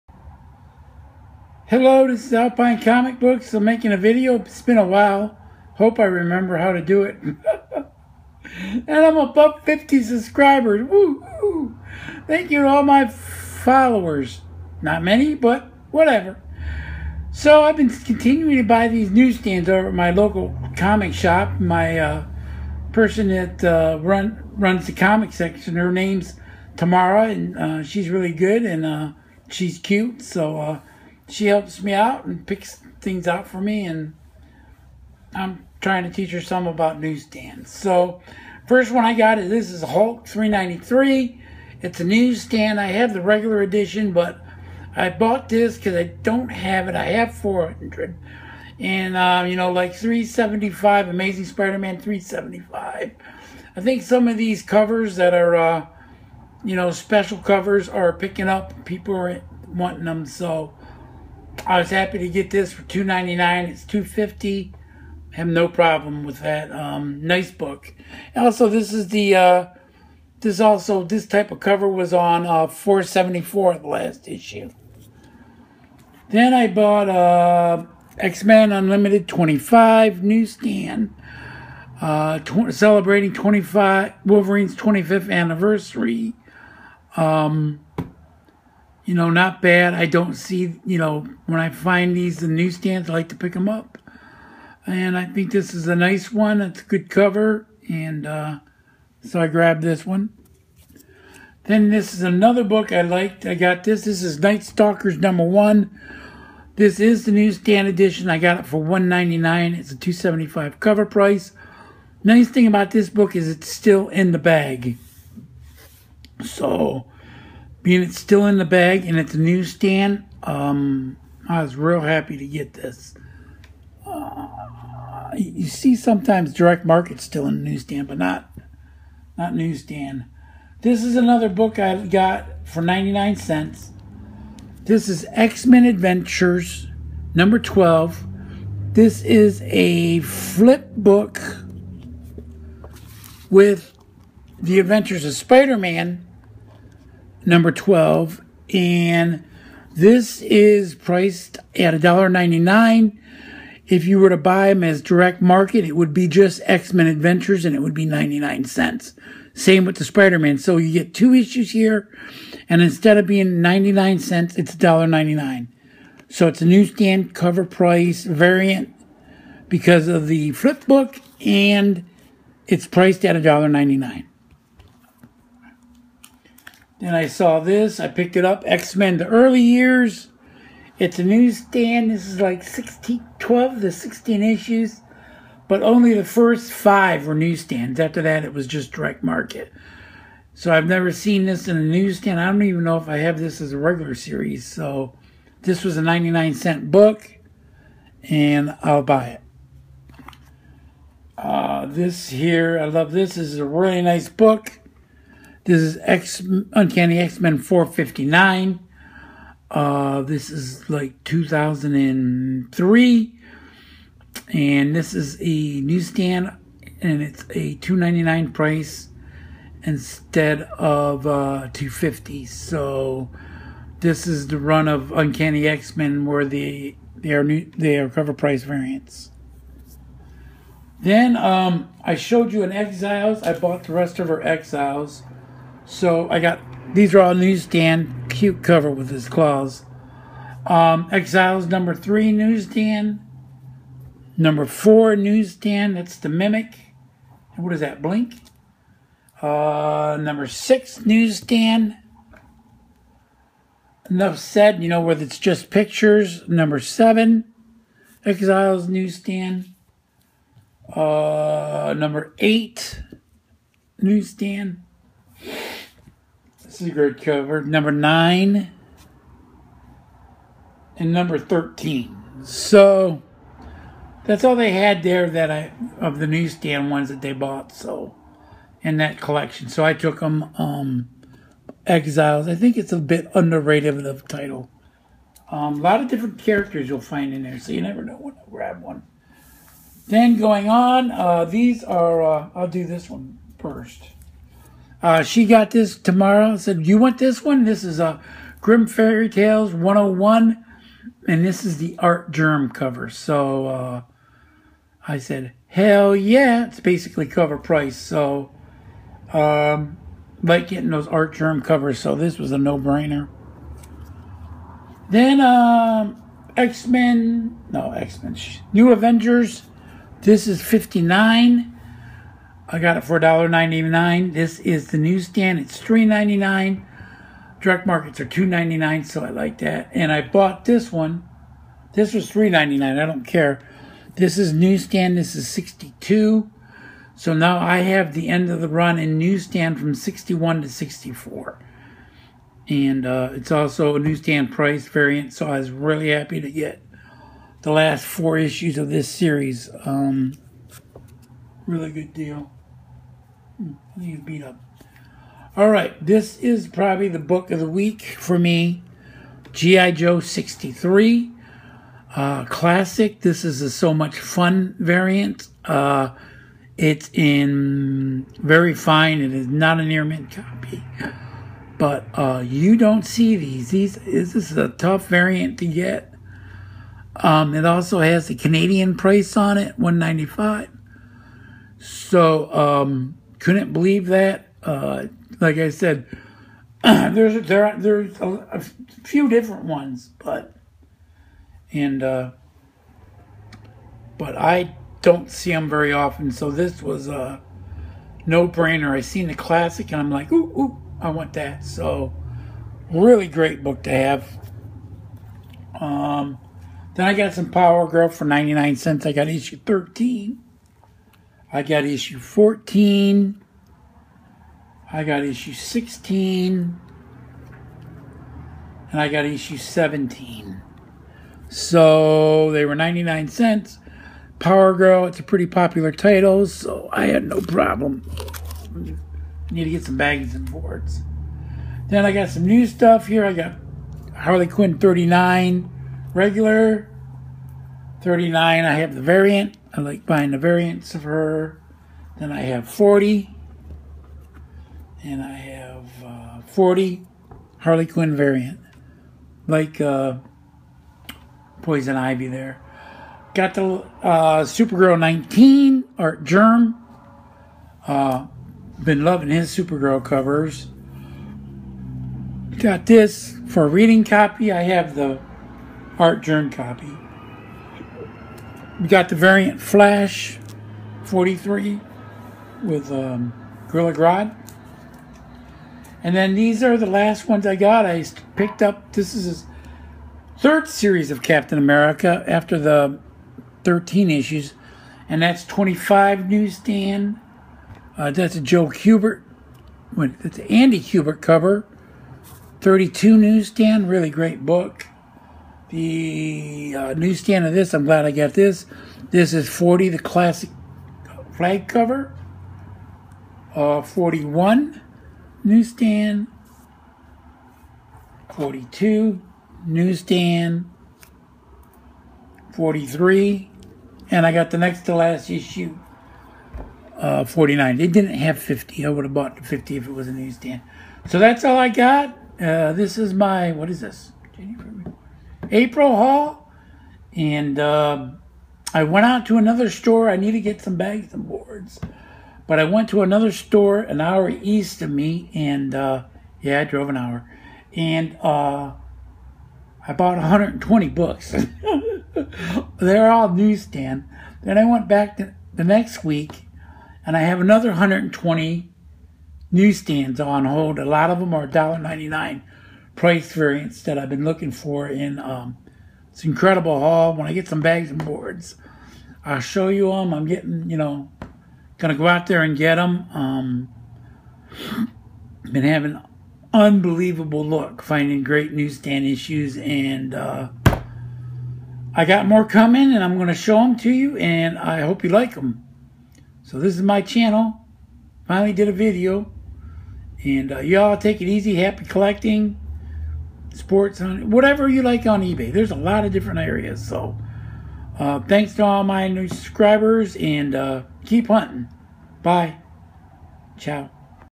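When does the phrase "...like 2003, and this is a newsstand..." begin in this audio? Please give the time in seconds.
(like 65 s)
210 s.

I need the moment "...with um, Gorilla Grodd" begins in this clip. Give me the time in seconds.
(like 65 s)
472 s.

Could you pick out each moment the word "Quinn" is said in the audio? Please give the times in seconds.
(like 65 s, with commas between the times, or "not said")
434 s, 447 s.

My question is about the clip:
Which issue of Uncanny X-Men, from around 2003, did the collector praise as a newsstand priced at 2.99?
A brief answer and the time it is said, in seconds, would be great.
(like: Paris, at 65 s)
459, at 206 s.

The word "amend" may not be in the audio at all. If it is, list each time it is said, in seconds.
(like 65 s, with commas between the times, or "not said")
not said.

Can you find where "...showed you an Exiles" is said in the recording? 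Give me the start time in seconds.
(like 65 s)
232 s.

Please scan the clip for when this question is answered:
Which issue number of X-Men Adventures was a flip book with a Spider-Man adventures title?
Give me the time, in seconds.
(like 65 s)
135 s.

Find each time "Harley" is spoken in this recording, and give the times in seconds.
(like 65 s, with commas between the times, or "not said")
434 s, 447 s.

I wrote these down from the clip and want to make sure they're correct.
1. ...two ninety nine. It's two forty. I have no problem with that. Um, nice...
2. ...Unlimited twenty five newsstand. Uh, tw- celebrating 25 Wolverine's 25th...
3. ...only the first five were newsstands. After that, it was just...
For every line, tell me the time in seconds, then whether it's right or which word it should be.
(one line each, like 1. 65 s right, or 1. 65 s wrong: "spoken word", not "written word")
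1. 62 s wrong: "fifty", not "forty"
2. 78 s right
3. 185 s right.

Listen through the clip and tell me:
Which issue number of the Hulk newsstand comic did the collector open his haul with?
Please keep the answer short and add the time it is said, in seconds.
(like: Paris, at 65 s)
393, at 39 s.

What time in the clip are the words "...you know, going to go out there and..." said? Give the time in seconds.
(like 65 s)
560 s.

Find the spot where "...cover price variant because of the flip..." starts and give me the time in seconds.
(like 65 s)
167 s.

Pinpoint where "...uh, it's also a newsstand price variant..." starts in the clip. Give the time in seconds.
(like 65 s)
343 s.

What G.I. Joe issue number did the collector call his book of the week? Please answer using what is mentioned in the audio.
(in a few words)
63.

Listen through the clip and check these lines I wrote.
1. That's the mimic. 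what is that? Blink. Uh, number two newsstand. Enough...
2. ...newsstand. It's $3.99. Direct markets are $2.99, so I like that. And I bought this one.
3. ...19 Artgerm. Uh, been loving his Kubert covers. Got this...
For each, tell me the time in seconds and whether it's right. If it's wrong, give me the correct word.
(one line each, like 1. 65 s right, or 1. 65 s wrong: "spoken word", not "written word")
1. 245 s wrong: "six", not "two"
2. 324 s right
3. 454 s wrong: "Supergirl", not "Kubert".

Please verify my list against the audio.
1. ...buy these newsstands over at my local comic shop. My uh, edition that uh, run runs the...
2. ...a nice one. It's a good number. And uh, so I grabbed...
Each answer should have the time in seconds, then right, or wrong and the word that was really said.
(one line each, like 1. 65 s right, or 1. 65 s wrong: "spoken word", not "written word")
1. 18 s wrong: "person", not "edition"
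2. 95 s wrong: "cover", not "number".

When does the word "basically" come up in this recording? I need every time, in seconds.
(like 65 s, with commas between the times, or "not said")
306 s.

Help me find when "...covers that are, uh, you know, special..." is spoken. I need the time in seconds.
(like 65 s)
54 s.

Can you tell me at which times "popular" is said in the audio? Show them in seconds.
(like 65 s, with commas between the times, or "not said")
425 s.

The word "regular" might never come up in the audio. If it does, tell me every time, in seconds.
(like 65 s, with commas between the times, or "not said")
43 s, 193 s, 436 s.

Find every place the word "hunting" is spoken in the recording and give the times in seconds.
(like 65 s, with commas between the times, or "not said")
591 s.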